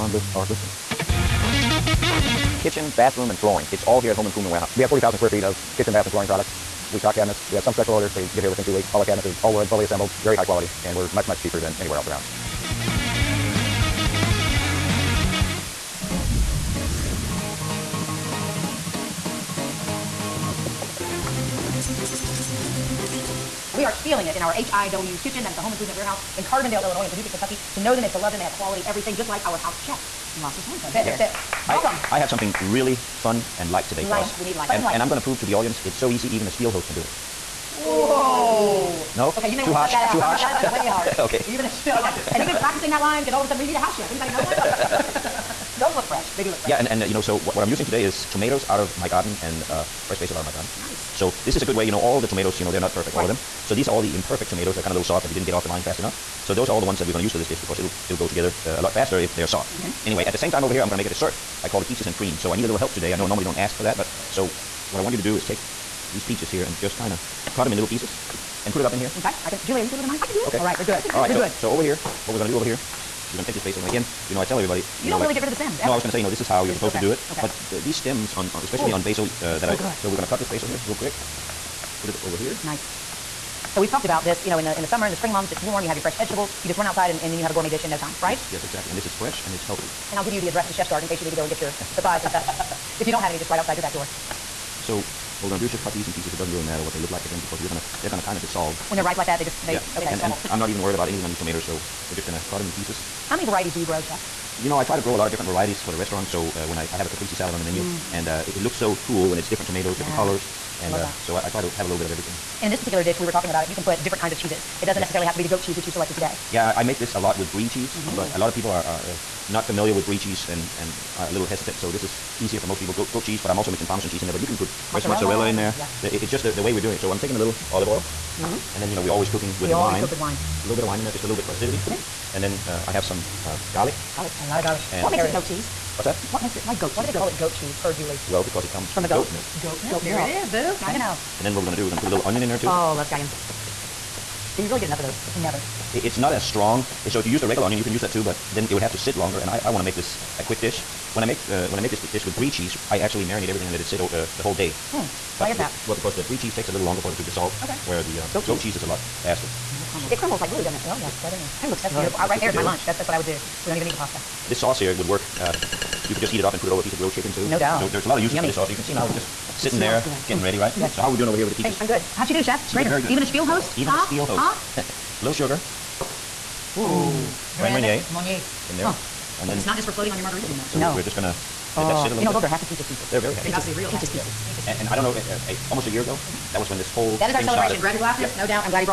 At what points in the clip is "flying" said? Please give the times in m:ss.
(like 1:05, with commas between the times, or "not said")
not said.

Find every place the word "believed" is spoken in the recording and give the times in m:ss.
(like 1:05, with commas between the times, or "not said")
not said.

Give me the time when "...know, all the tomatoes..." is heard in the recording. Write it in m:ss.
0:51.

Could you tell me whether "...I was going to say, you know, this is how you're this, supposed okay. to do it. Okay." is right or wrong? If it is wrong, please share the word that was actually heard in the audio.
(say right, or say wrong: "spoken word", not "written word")
right.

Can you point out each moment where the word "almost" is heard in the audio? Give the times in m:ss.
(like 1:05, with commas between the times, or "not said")
3:05.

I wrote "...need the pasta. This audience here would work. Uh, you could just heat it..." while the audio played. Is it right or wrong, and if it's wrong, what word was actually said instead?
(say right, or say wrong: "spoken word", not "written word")
wrong: "sauce", not "audience".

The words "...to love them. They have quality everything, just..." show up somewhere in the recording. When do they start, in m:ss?
0:28.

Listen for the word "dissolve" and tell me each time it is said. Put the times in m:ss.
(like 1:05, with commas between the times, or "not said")
1:38, 2:37.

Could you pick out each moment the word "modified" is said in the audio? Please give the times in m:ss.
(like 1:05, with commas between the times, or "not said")
not said.